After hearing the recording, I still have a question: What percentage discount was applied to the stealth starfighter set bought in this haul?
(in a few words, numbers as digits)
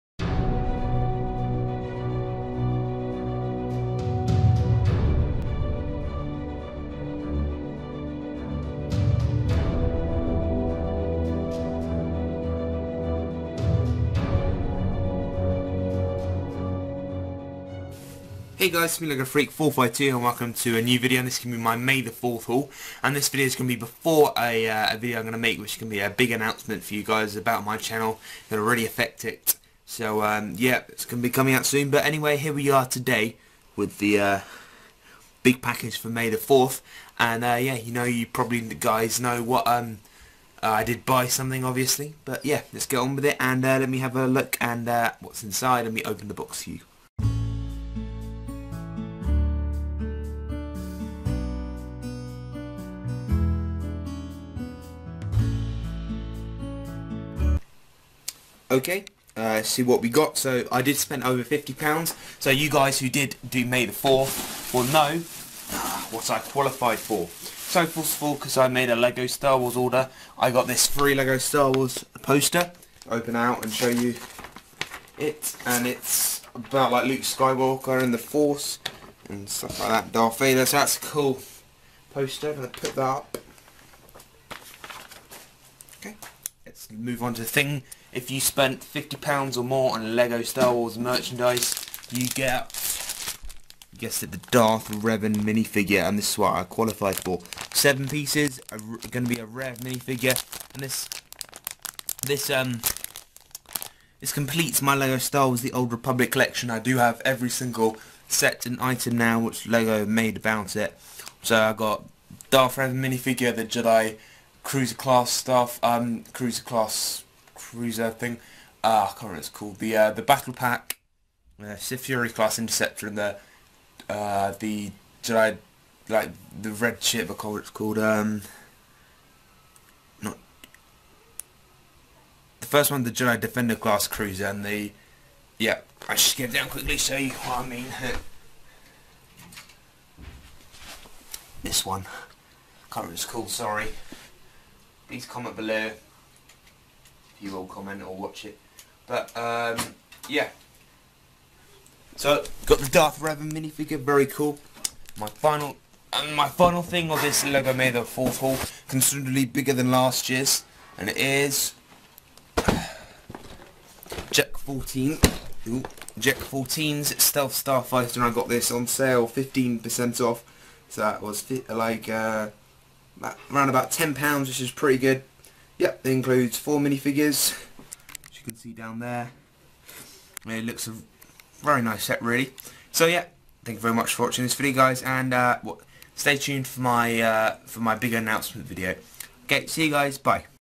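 15%.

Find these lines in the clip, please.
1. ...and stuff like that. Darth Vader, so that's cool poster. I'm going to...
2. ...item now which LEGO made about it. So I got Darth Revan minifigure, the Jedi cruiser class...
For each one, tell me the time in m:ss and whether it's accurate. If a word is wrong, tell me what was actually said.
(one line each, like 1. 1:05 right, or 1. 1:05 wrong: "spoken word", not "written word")
1. 1:19 right
2. 1:48 right.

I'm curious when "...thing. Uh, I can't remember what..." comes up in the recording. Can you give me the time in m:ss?
1:58.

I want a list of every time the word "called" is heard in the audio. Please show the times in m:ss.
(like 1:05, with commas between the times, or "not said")
1:59, 2:07, 2:23.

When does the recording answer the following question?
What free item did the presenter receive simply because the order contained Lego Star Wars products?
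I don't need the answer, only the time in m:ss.
1:11.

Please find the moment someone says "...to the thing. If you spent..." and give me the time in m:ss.
1:27.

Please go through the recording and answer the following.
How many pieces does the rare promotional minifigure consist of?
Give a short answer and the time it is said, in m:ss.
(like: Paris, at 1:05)
7, at 1:37.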